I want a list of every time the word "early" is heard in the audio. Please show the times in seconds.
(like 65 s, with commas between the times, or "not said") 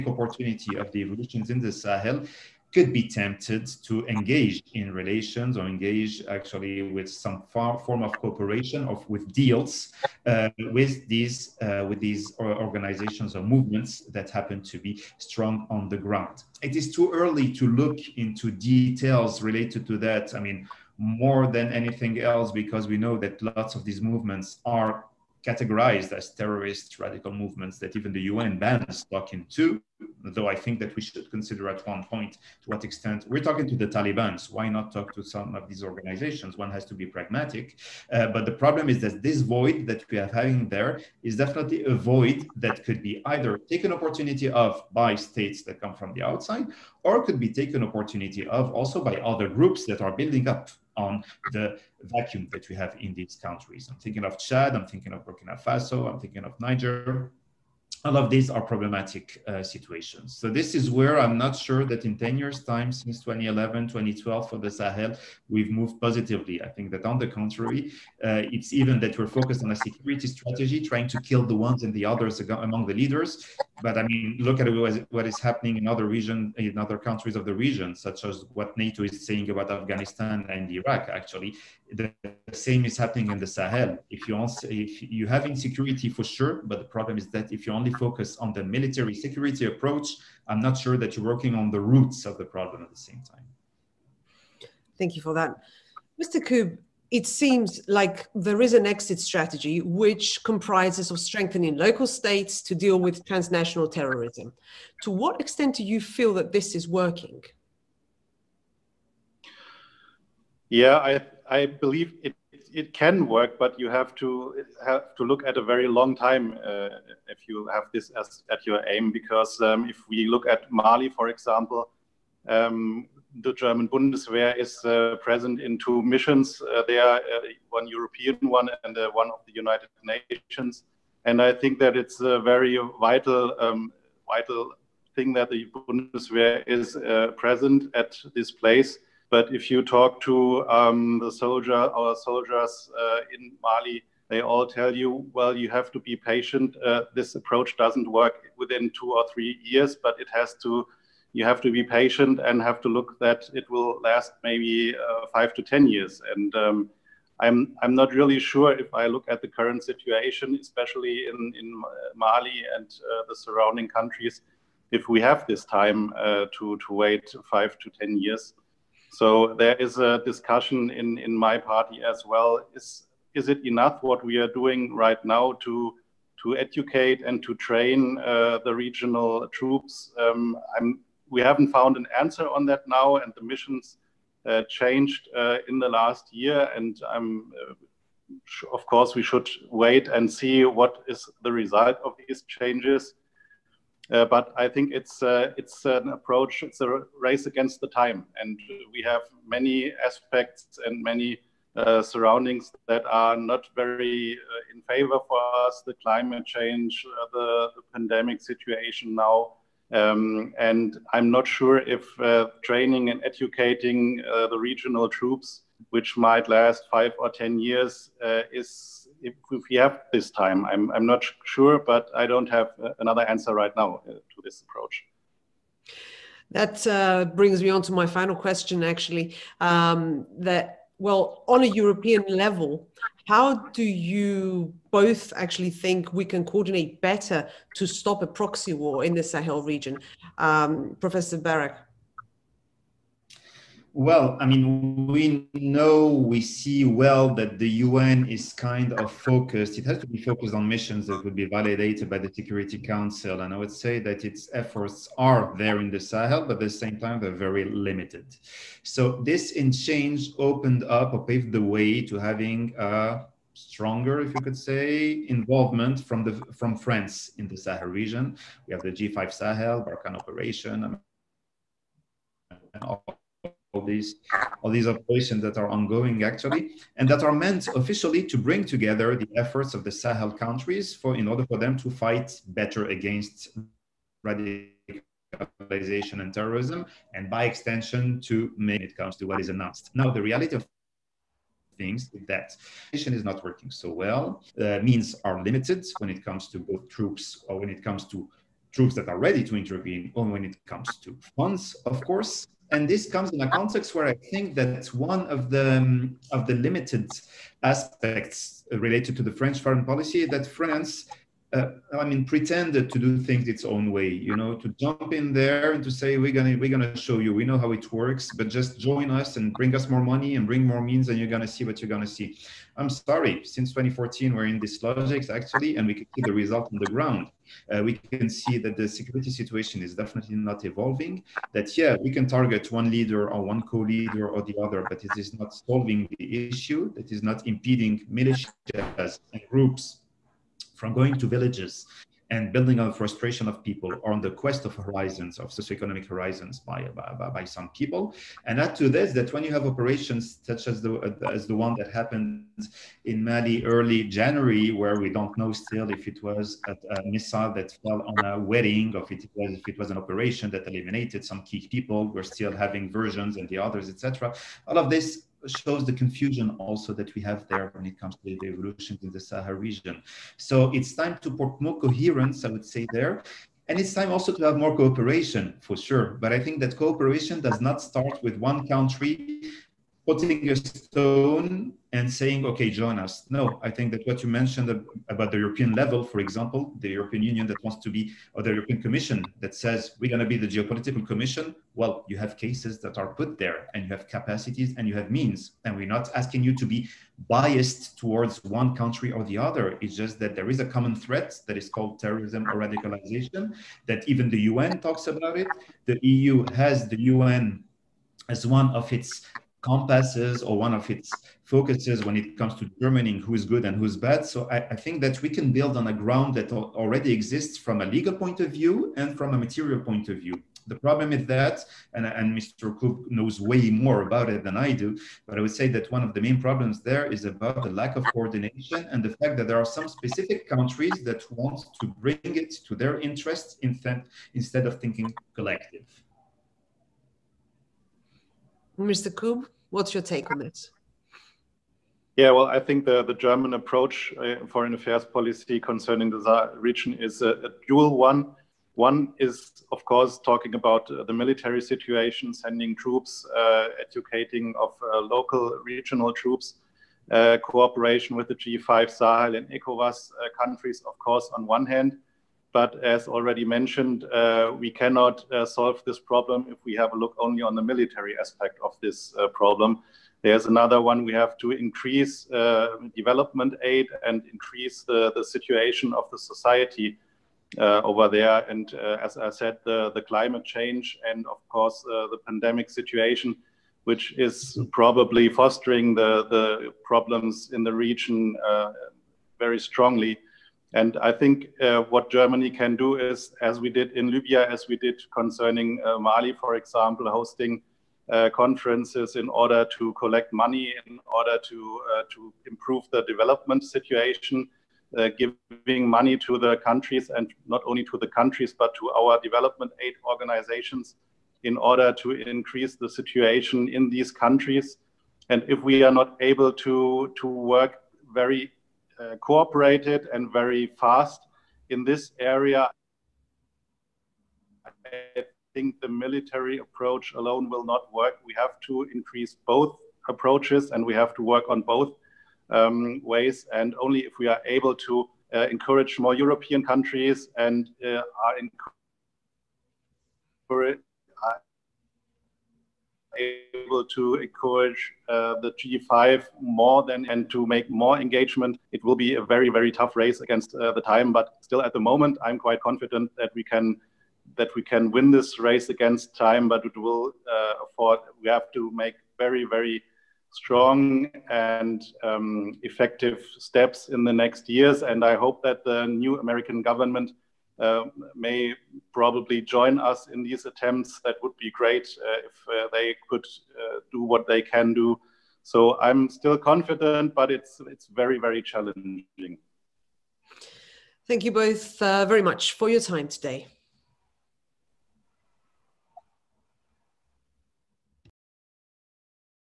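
17 s, 353 s.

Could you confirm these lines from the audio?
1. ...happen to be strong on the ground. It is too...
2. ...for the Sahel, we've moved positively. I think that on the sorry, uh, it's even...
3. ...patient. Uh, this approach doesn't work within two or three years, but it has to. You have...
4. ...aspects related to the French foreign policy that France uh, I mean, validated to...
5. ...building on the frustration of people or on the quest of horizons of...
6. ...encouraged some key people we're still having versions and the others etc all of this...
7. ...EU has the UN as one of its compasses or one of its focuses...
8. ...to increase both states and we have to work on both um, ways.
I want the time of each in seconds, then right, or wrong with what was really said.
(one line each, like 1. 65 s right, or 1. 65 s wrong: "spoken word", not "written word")
1. 14 s right
2. 64 s wrong: "contrary", not "sorry"
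3. 146 s right
4. 307 s wrong: "pretended", not "validated"
5. 342 s right
6. 360 s wrong: "eliminated", not "encouraged"
7. 406 s right
8. 528 s wrong: "approaches", not "states".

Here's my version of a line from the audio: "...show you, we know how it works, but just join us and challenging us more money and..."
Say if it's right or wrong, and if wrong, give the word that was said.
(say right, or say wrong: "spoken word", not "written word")
wrong: "bring", not "challenging".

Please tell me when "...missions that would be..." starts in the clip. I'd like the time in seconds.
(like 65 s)
250 s.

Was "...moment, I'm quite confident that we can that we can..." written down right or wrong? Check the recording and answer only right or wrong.
right.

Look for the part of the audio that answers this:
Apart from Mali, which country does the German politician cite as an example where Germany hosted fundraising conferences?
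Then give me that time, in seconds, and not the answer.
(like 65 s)
494 s.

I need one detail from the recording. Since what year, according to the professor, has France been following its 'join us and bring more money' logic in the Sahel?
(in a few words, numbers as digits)
2014.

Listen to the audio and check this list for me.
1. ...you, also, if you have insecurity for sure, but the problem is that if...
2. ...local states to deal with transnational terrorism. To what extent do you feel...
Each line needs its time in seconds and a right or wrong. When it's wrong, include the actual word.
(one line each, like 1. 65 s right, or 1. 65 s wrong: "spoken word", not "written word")
1. 84 s right
2. 101 s right.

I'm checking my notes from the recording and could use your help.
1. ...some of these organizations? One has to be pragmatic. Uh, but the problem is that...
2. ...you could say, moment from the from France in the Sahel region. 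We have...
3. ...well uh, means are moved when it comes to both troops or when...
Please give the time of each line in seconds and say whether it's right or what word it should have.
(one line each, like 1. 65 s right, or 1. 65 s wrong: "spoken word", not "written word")
1. 35 s right
2. 264 s wrong: "involvement", not "moment"
3. 293 s wrong: "limited", not "moved".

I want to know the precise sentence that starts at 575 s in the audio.
So I'm still confident, but it's it's very very challenging.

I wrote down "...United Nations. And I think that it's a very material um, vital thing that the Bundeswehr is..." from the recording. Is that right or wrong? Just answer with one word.
wrong.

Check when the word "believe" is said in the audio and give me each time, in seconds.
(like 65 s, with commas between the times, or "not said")
111 s.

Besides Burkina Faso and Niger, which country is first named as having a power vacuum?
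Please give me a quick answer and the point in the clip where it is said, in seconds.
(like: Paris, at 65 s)
Chad, at 54 s.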